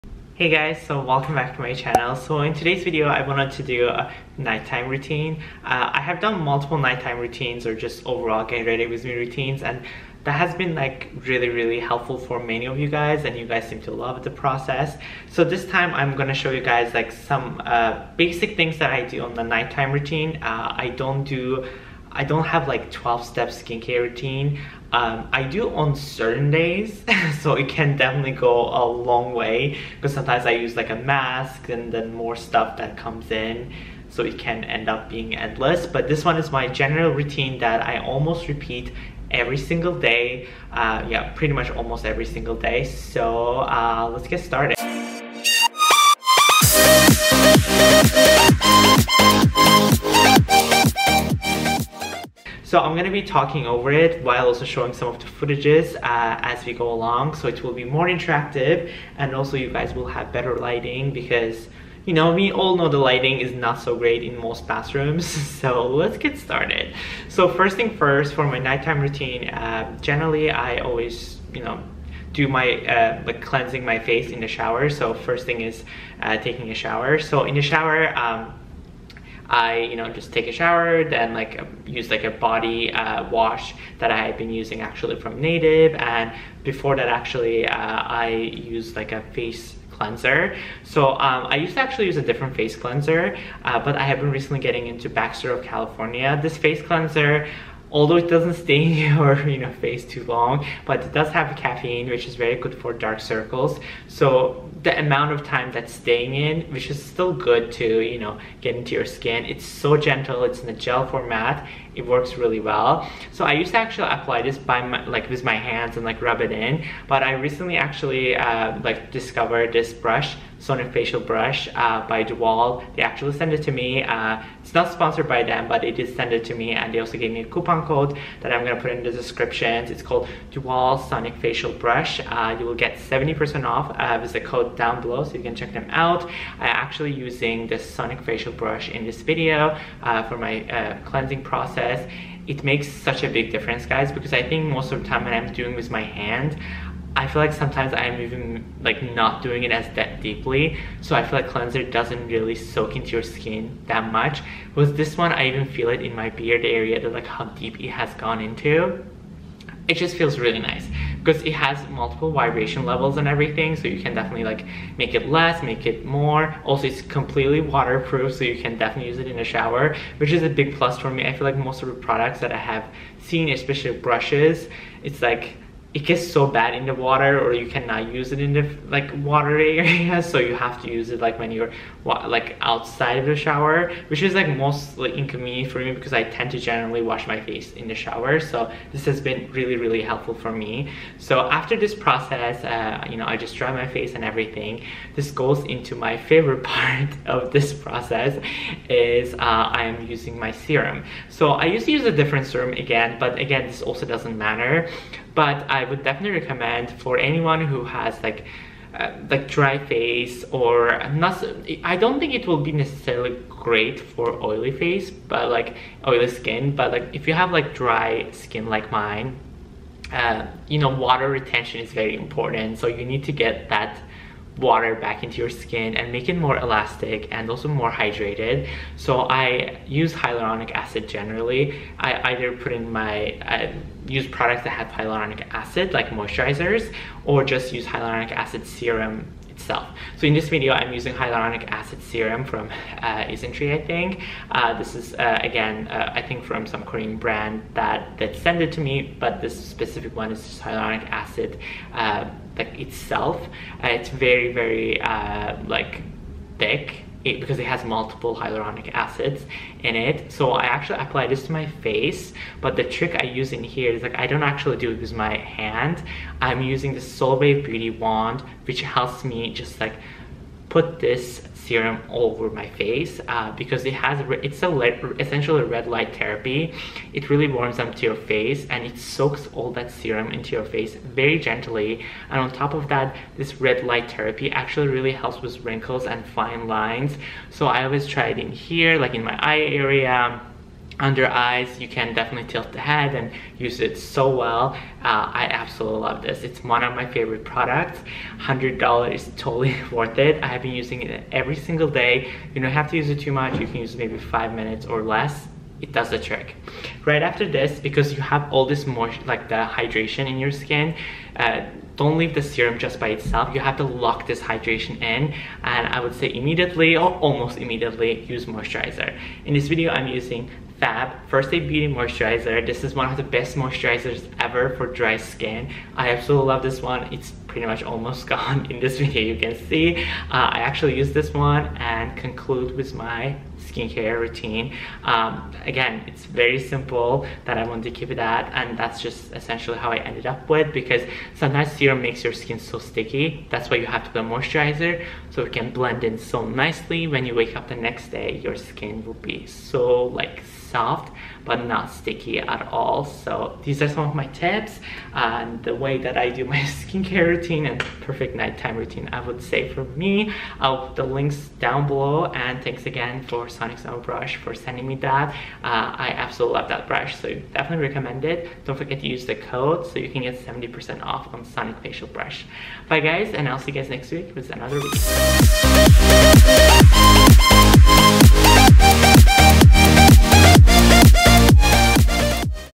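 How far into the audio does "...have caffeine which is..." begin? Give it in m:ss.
1:41.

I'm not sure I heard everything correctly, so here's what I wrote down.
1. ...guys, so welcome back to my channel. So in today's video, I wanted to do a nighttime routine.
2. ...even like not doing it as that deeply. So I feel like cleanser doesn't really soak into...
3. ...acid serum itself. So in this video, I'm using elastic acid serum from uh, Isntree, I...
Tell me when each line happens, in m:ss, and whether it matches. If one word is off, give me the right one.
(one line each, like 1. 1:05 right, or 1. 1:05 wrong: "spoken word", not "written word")
1. 0:00 right
2. 2:28 right
3. 3:58 wrong: "hyaluronic", not "elastic".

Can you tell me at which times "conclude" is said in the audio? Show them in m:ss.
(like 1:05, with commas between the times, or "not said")
5:32.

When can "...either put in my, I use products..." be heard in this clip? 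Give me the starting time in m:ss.
3:52.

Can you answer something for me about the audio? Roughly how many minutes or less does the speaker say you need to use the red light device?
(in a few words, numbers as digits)
5.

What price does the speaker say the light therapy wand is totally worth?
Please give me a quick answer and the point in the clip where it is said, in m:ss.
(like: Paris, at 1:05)
$100, at 4:58.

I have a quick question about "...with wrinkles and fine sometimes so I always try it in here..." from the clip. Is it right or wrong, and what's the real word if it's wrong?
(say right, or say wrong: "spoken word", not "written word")
wrong: "lines", not "sometimes".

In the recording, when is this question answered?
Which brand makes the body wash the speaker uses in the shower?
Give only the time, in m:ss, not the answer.
1:25.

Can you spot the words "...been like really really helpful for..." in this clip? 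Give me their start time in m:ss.
0:10.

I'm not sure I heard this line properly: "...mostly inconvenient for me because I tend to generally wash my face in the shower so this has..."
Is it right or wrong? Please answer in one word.
right.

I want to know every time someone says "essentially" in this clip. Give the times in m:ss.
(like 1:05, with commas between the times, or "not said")
4:35, 5:39.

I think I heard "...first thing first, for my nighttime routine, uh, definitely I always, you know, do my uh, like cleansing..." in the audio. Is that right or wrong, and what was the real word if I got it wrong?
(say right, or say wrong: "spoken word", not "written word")
wrong: "generally", not "definitely".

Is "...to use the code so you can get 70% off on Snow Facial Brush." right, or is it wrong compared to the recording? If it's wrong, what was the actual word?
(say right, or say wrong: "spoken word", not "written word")
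wrong: "Sonic", not "Snow".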